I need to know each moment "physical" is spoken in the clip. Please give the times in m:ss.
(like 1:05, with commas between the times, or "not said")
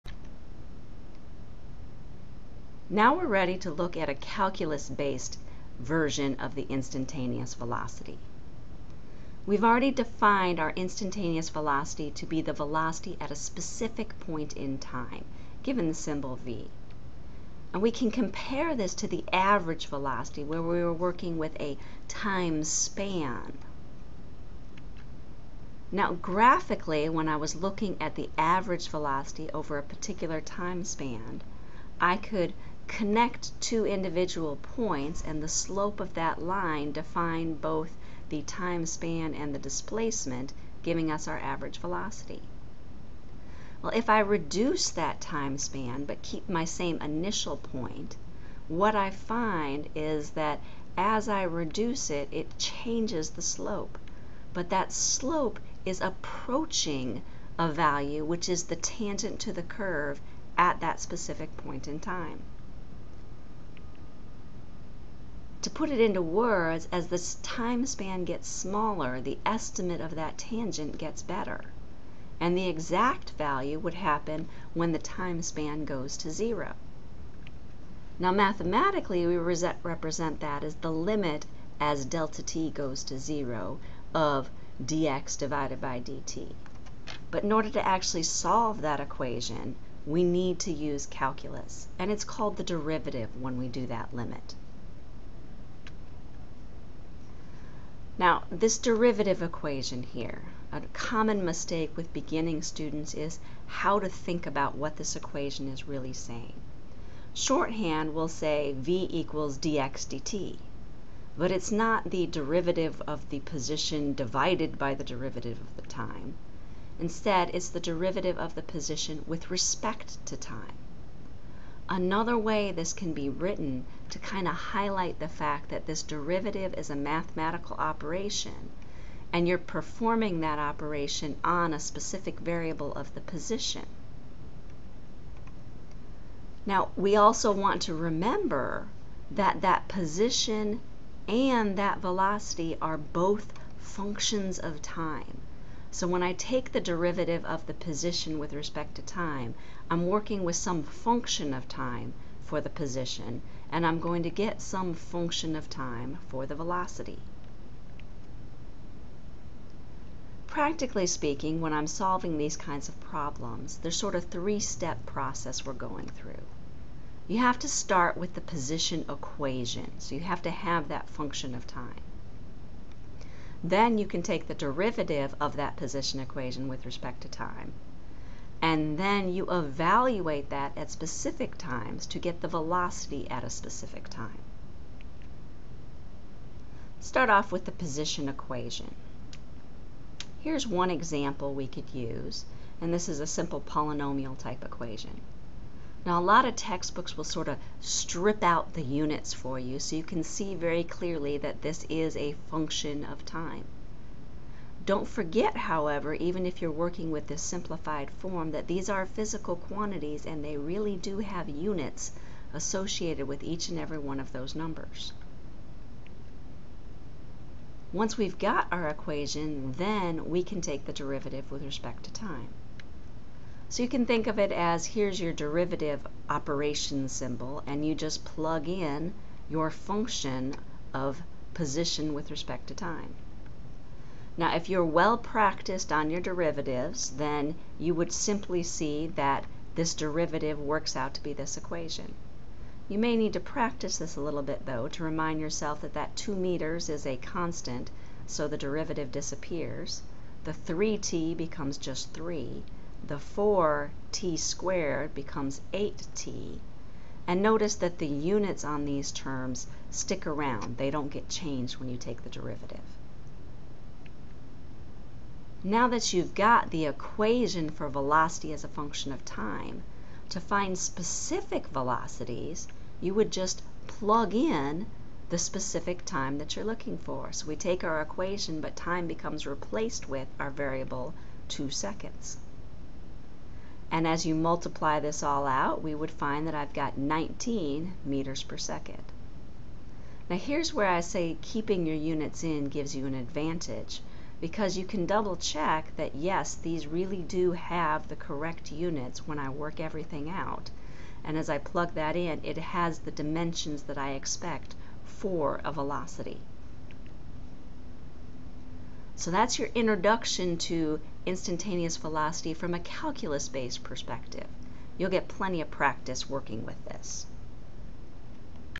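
3:29.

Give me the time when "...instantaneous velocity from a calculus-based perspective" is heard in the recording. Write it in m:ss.
5:11.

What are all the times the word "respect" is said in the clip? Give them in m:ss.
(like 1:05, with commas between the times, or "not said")
1:59, 2:28, 2:56, 3:41, 3:52.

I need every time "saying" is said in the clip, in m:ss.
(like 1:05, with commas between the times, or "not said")
1:46.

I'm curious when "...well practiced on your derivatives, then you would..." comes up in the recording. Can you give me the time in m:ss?
3:54.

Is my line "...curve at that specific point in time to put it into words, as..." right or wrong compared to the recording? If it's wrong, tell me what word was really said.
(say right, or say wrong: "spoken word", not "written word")
right.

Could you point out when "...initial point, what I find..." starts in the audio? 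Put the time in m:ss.
0:47.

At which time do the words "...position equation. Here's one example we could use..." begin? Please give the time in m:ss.
3:07.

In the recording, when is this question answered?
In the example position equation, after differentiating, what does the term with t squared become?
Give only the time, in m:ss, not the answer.
4:15.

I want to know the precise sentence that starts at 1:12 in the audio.
And the exact value would happen when the time span goes to zero.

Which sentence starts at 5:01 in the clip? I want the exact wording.
And as I plug that in, it has the dimensions that I expect for a velocity.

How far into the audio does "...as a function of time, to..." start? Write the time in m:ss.
4:28.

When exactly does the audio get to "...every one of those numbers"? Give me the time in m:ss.
3:33.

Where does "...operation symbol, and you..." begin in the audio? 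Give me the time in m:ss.
3:46.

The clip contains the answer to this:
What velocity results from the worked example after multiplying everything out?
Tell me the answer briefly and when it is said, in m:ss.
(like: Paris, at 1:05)
19 meters per second, at 4:46.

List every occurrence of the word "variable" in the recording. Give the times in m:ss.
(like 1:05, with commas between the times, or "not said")
2:12, 4:40.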